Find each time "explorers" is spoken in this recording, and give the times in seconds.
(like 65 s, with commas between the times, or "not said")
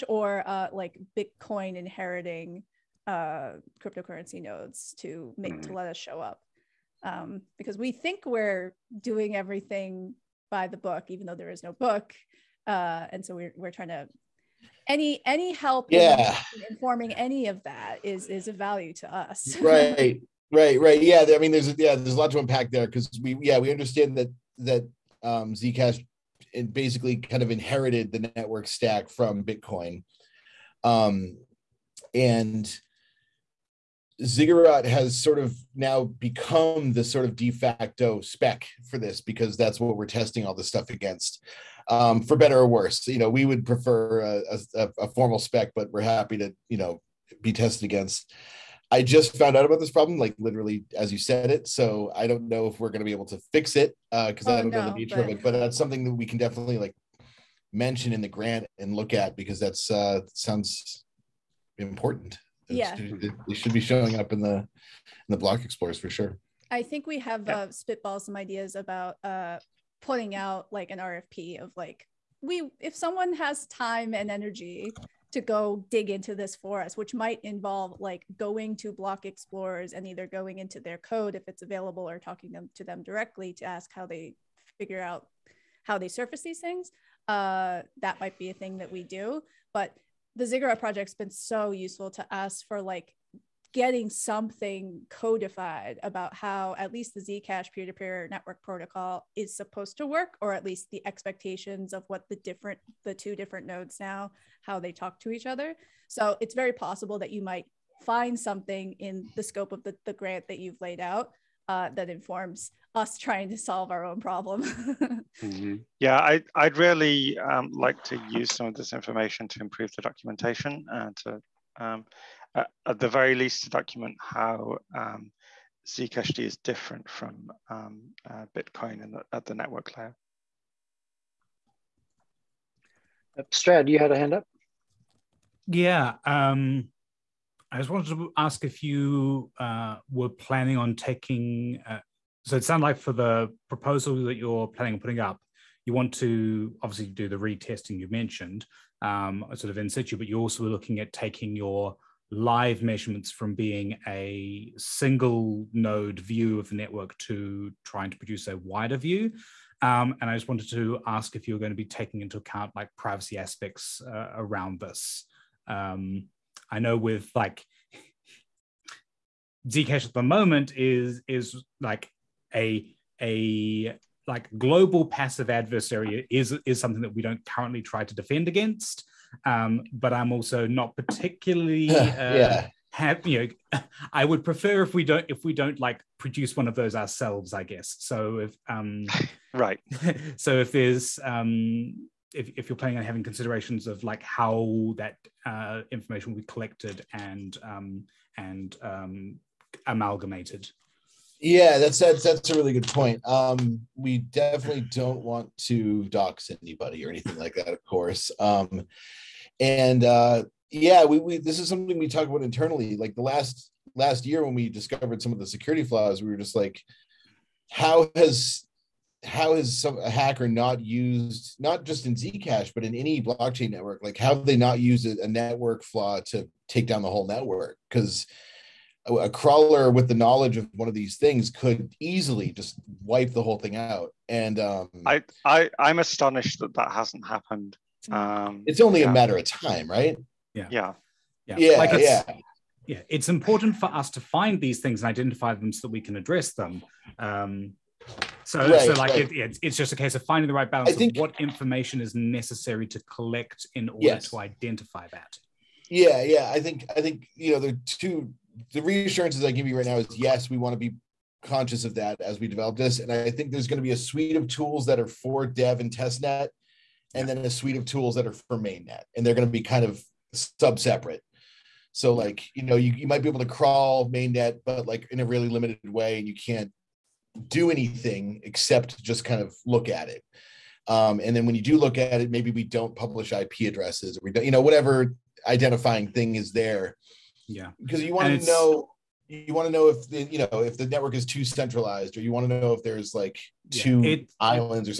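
65 s, 79 s.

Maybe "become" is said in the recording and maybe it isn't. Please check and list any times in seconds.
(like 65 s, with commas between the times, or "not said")
36 s.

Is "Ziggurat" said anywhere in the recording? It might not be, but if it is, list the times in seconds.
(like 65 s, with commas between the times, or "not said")
34 s, 90 s.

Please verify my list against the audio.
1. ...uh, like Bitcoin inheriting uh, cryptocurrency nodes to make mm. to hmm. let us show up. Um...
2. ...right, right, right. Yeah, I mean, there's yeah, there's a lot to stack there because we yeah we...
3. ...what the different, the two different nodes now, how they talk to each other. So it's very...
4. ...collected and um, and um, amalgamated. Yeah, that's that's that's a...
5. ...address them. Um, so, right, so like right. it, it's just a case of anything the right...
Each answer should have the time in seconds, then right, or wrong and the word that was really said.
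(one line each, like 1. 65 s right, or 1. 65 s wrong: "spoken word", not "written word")
1. 0 s right
2. 19 s wrong: "unpack", not "stack"
3. 102 s right
4. 196 s right
5. 246 s wrong: "finding", not "anything".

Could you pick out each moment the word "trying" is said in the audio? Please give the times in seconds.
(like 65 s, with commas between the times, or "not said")
13 s, 113 s, 157 s.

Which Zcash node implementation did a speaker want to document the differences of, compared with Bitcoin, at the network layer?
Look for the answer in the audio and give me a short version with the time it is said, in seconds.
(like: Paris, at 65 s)
Zcash-D, at 125 s.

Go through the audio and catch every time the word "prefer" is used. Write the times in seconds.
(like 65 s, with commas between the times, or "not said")
43 s, 184 s.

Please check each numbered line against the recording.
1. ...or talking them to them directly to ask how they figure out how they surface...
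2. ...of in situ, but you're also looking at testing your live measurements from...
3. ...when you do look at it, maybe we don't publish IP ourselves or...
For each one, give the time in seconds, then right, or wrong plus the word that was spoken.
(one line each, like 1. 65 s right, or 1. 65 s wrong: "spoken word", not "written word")
1. 82 s right
2. 149 s wrong: "taking", not "testing"
3. 281 s wrong: "addresses", not "ourselves".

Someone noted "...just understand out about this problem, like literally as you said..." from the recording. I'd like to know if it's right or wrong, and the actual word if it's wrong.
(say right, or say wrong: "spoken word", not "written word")
wrong: "found", not "understand".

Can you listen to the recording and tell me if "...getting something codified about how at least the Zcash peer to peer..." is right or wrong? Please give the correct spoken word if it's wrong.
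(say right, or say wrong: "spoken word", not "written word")
right.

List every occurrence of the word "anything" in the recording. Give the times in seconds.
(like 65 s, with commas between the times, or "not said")
207 s, 277 s.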